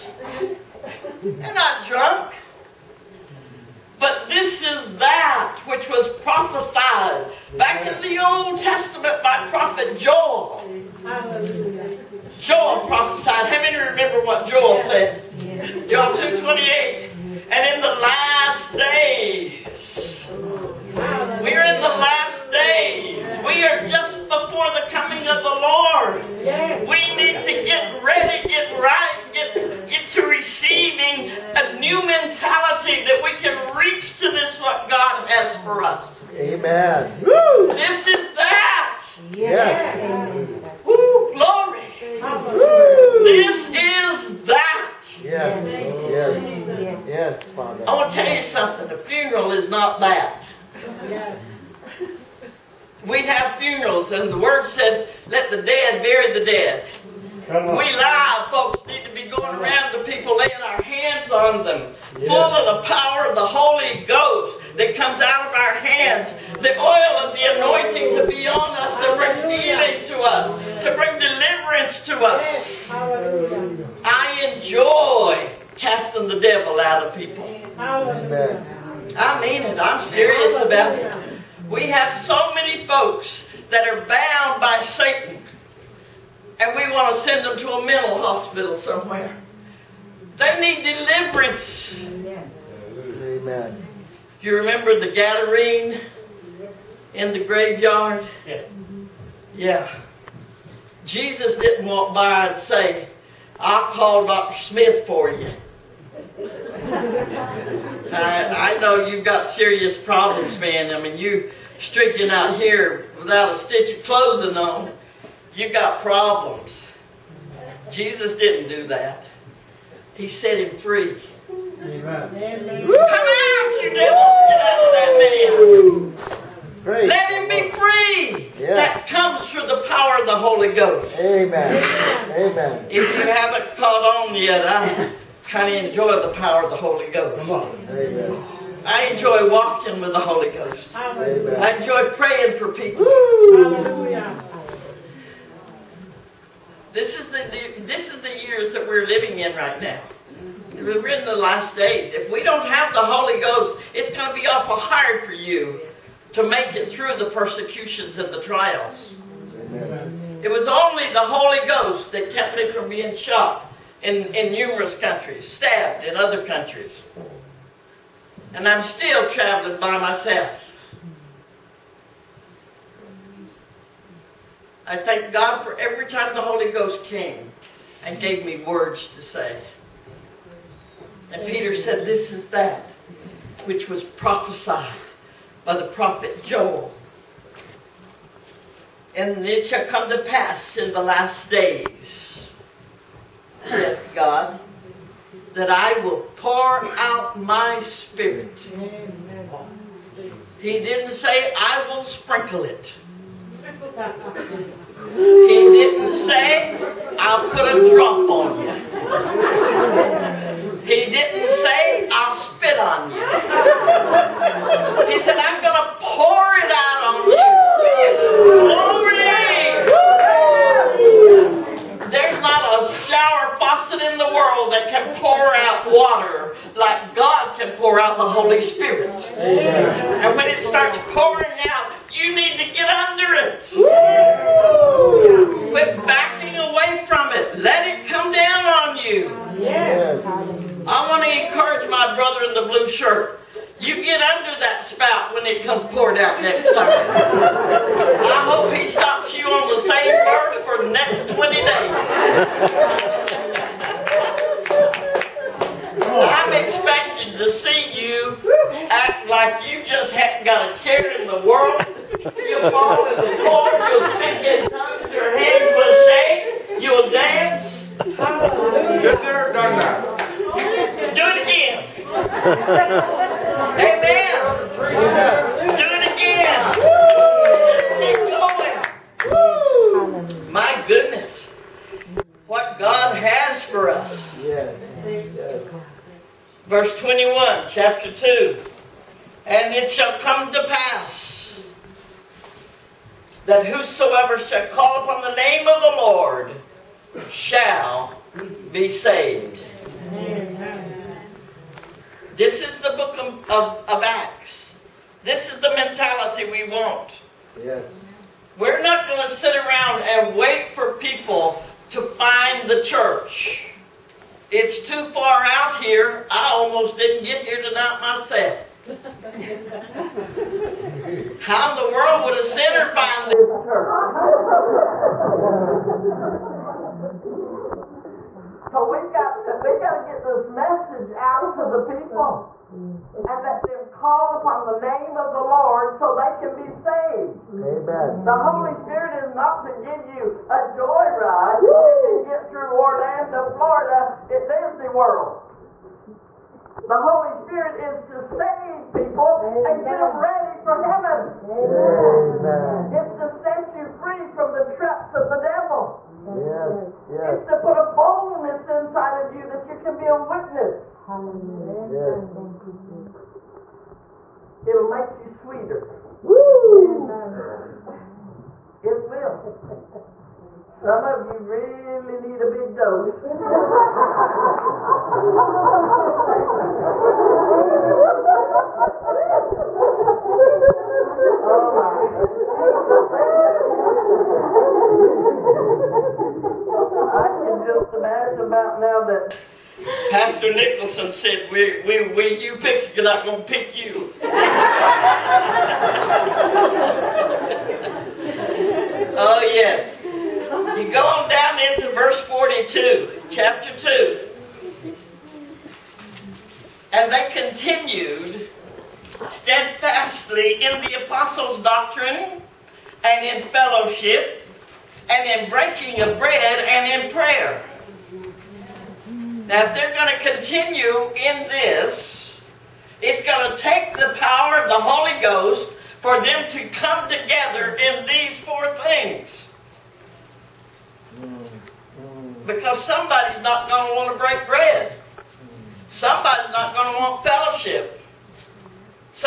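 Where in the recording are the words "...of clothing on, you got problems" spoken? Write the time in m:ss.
1:53.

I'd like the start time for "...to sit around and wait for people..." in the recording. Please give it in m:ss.
5:09.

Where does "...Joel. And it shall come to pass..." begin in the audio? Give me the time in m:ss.
3:06.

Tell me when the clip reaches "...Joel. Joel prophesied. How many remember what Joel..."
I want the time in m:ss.
0:09.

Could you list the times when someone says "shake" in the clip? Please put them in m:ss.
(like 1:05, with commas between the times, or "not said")
4:26.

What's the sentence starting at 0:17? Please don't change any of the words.
And in the last days, we're in the last days.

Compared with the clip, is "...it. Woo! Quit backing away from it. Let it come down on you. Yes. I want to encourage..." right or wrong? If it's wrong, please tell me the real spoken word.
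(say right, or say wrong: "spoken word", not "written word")
right.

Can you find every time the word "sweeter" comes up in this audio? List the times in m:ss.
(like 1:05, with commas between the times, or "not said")
6:05.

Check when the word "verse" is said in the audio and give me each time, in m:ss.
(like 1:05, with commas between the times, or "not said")
4:46, 6:41.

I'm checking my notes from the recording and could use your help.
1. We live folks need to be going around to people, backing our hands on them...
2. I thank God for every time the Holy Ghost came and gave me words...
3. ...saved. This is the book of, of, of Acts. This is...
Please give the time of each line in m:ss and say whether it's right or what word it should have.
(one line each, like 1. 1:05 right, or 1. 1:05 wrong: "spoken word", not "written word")
1. 0:57 wrong: "laying", not "backing"
2. 2:54 right
3. 4:58 right.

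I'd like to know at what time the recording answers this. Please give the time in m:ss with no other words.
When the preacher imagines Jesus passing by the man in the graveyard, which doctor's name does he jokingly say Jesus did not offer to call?
1:44.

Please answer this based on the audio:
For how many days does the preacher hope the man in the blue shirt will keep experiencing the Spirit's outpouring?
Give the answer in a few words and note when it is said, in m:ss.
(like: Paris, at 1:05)
20, at 4:11.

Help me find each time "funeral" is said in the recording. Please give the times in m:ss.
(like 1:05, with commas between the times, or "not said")
0:48, 0:53.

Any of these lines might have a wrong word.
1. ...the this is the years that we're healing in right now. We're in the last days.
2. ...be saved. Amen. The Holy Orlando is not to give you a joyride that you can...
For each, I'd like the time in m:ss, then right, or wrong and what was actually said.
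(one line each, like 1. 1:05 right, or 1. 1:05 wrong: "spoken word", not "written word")
1. 2:27 wrong: "living", not "healing"
2. 5:36 wrong: "Spirit", not "Orlando".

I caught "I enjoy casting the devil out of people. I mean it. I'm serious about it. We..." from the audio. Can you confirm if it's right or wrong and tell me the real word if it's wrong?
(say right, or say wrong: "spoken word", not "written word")
right.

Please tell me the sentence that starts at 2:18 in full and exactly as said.
I enjoy walking with the Holy Ghost.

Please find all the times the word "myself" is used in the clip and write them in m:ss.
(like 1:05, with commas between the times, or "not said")
2:49, 5:17.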